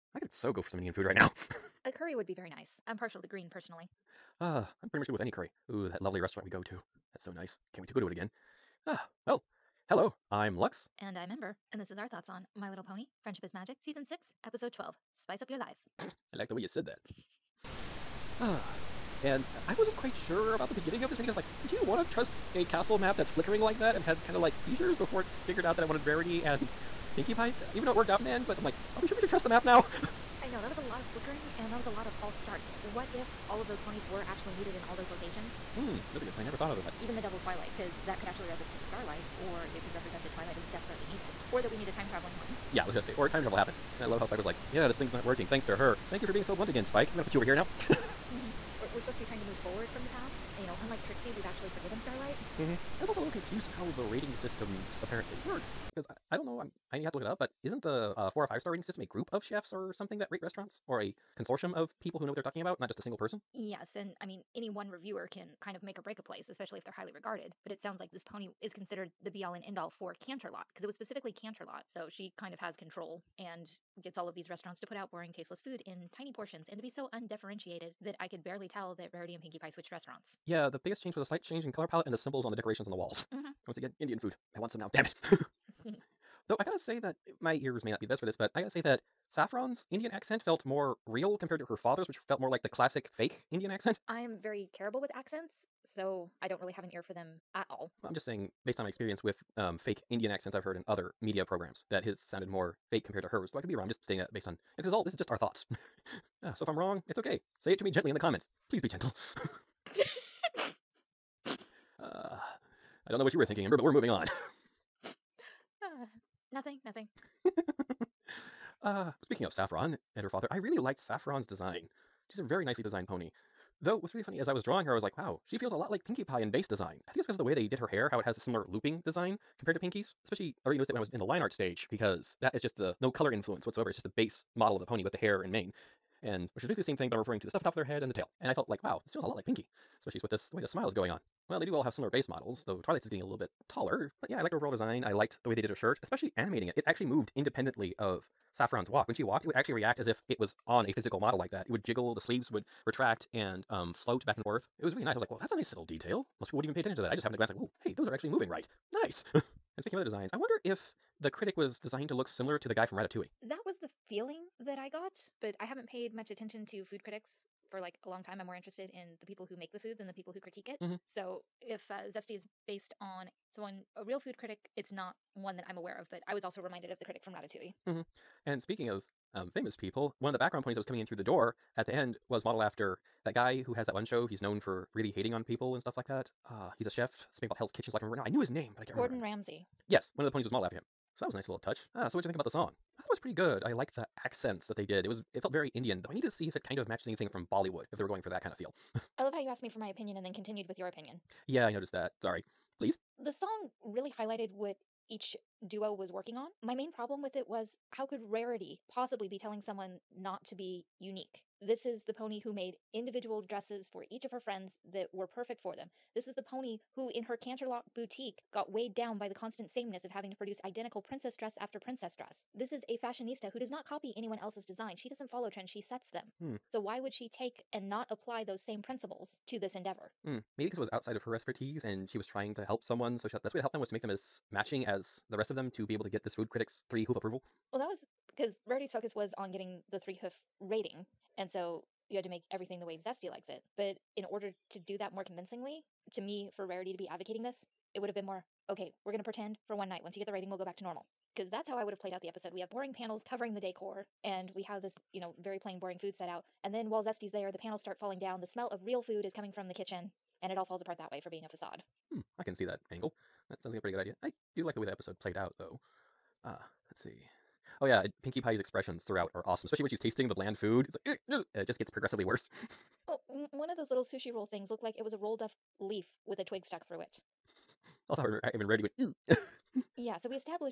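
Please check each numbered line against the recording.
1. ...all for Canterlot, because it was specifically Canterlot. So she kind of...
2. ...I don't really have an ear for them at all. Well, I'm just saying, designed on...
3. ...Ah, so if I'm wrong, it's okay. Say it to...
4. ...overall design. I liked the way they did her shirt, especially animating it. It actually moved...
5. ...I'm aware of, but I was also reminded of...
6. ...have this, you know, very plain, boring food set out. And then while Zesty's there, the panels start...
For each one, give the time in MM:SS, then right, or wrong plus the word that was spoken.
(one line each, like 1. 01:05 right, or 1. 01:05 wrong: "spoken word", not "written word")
1. 01:09 right
2. 01:36 wrong: "based", not "designed"
3. 01:46 right
4. 02:24 right
5. 02:55 right
6. 04:14 right.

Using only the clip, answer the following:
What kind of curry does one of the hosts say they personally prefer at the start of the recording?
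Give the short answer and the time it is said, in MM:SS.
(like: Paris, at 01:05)
green, at 00:03.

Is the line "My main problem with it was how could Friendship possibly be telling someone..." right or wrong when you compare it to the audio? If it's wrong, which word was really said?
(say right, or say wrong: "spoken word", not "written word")
wrong: "Rarity", not "Friendship".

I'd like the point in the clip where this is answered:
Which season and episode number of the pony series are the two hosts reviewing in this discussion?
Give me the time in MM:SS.
00:13.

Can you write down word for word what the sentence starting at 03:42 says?
This is a fashionista who does not copy anyone else's design.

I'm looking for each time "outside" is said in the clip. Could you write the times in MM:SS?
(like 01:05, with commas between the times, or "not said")
03:50.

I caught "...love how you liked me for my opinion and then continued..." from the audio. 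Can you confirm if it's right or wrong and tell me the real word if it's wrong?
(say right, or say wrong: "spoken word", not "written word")
wrong: "asked", not "liked".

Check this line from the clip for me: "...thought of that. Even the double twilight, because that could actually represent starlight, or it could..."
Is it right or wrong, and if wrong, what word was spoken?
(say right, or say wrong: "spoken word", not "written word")
right.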